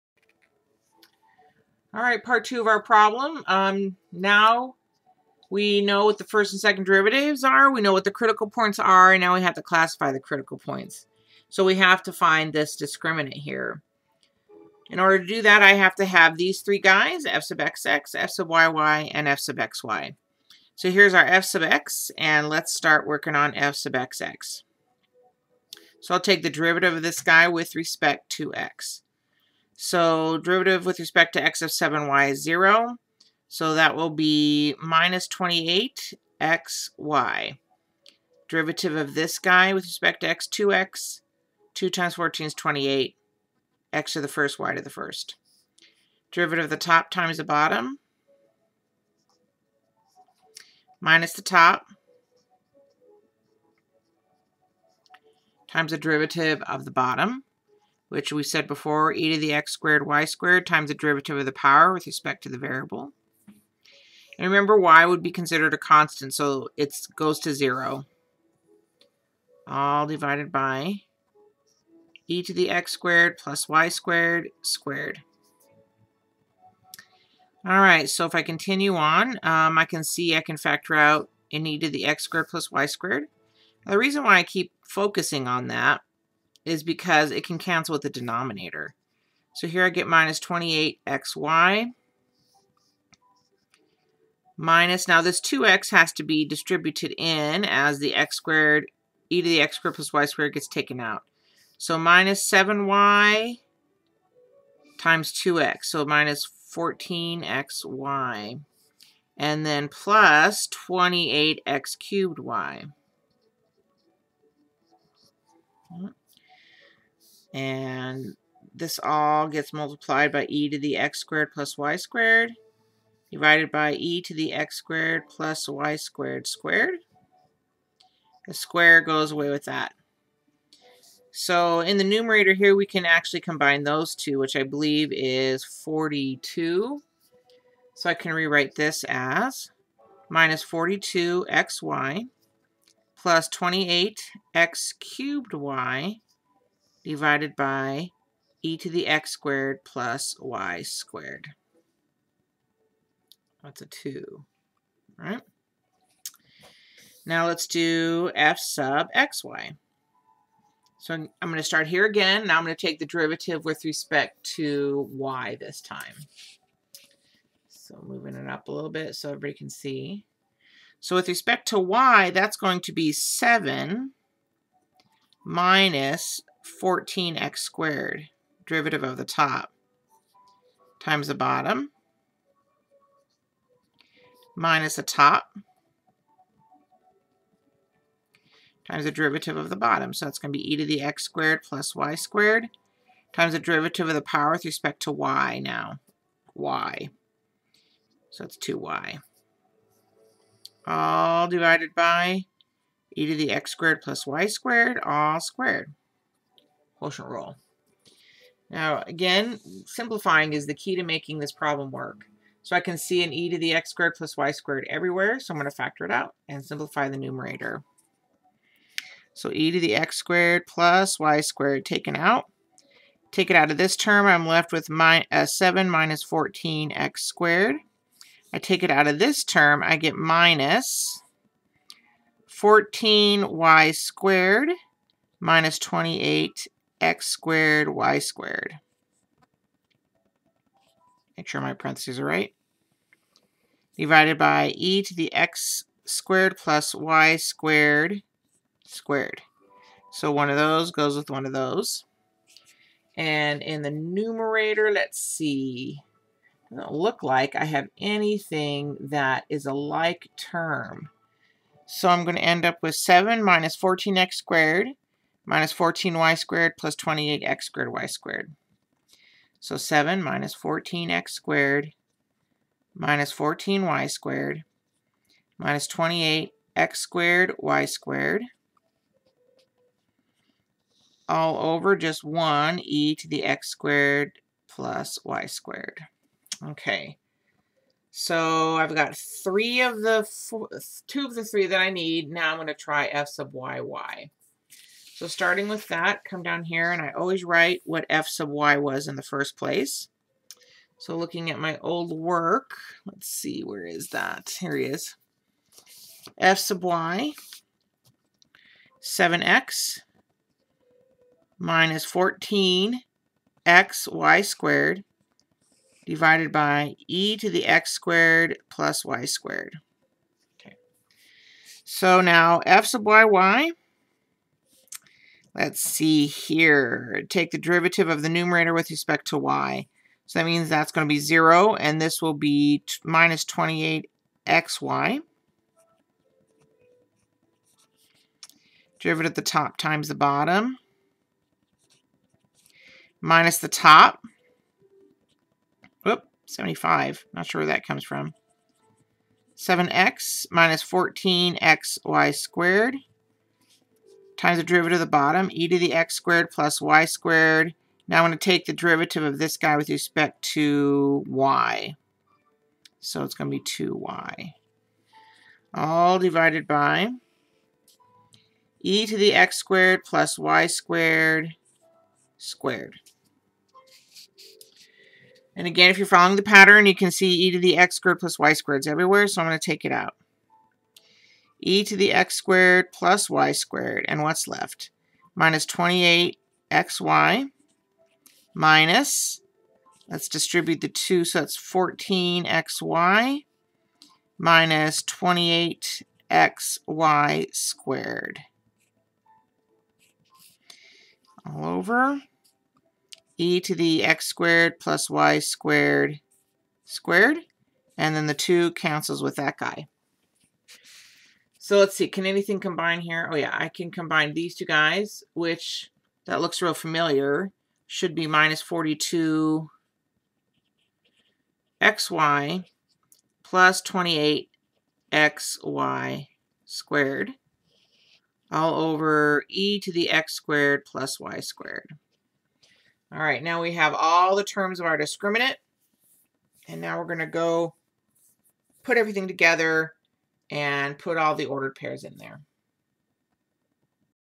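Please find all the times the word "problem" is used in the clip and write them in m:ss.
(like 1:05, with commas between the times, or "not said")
0:02, 3:31.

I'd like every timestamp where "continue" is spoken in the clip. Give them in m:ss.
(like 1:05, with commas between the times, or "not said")
1:18.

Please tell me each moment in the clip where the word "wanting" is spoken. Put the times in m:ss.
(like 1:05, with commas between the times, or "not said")
not said.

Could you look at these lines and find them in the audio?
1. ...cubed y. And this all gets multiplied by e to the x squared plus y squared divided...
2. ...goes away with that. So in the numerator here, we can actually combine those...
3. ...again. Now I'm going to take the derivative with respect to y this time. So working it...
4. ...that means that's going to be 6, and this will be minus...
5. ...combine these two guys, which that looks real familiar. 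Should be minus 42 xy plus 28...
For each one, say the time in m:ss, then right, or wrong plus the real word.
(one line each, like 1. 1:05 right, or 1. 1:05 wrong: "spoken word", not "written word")
1. 1:51 right
2. 2:09 right
3. 2:42 wrong: "moving", not "working"
4. 5:30 wrong: "0", not "6"
5. 6:53 right.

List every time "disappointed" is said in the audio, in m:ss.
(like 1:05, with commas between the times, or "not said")
not said.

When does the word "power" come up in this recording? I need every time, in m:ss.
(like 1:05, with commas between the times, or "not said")
1:01, 3:14.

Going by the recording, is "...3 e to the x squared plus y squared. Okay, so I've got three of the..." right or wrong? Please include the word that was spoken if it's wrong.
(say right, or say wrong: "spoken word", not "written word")
wrong: "1", not "3".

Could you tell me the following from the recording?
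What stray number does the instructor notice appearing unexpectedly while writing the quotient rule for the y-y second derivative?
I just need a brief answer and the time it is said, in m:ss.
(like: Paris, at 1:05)
75, at 5:46.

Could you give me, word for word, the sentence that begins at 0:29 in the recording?
So derivative with respect to x of 7y is 0.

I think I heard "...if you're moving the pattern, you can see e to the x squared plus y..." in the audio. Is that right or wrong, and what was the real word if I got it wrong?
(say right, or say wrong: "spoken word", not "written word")
wrong: "following", not "moving".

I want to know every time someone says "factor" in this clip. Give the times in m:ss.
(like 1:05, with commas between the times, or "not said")
1:20, 3:35.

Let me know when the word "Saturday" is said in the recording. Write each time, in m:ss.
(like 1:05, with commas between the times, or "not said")
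not said.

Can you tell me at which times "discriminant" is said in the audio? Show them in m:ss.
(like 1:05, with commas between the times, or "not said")
0:12, 7:14.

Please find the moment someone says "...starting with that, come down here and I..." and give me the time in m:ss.
4:55.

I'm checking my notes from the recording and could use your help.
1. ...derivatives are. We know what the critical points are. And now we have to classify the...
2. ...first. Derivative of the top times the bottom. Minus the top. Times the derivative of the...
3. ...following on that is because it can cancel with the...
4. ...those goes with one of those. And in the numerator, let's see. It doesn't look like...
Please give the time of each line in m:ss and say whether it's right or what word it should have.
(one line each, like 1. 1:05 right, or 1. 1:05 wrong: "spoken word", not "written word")
1. 0:06 right
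2. 0:44 right
3. 1:24 wrong: "focusing", not "following"
4. 4:10 right.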